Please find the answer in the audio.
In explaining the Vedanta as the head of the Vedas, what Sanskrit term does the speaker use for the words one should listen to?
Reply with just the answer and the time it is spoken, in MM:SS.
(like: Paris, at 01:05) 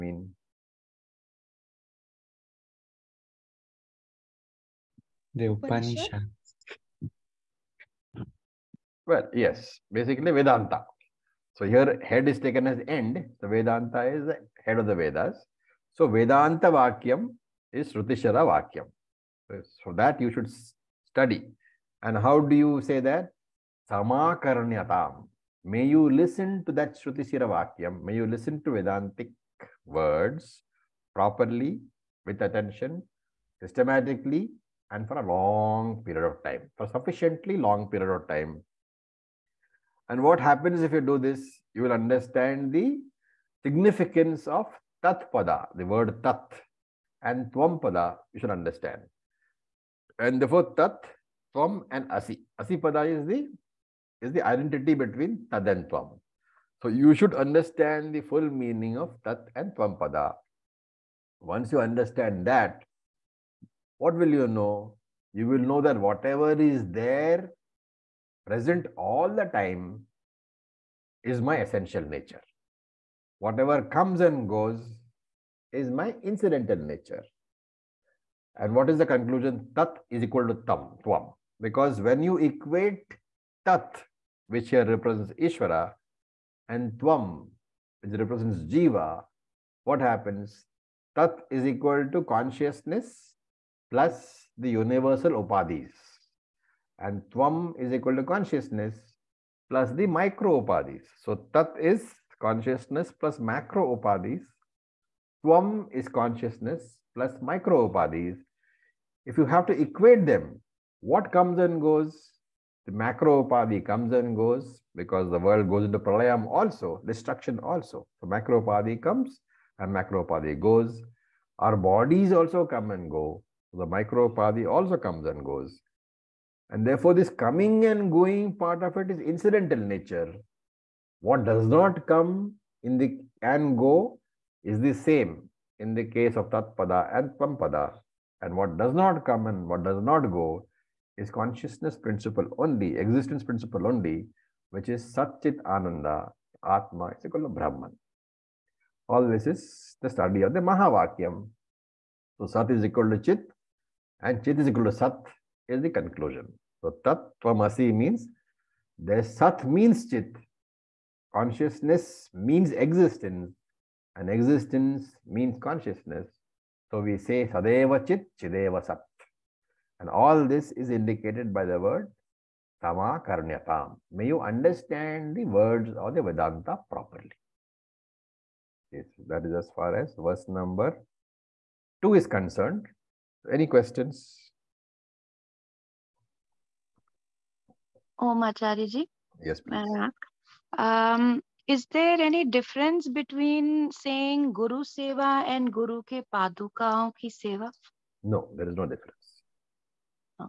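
Srutishara Vakyam, at 00:17.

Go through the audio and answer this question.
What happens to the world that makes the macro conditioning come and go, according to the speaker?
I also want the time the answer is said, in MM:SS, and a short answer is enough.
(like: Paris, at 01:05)
pralayam, at 01:55.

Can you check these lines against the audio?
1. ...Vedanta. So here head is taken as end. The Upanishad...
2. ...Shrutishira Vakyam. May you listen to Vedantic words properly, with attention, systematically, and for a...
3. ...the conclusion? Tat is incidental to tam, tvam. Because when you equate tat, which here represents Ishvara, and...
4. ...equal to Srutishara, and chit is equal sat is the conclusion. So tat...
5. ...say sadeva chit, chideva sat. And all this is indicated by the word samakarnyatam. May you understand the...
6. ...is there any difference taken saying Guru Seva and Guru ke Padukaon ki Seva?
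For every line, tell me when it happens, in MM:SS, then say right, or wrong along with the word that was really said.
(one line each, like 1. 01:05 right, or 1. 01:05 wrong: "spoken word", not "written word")
1. 00:10 wrong: "Vedanta", not "Upanishad"
2. 00:26 right
3. 01:18 wrong: "equal", not "incidental"
4. 02:32 wrong: "Chit", not "Srutishara"
5. 02:47 right
6. 03:11 wrong: "between", not "taken".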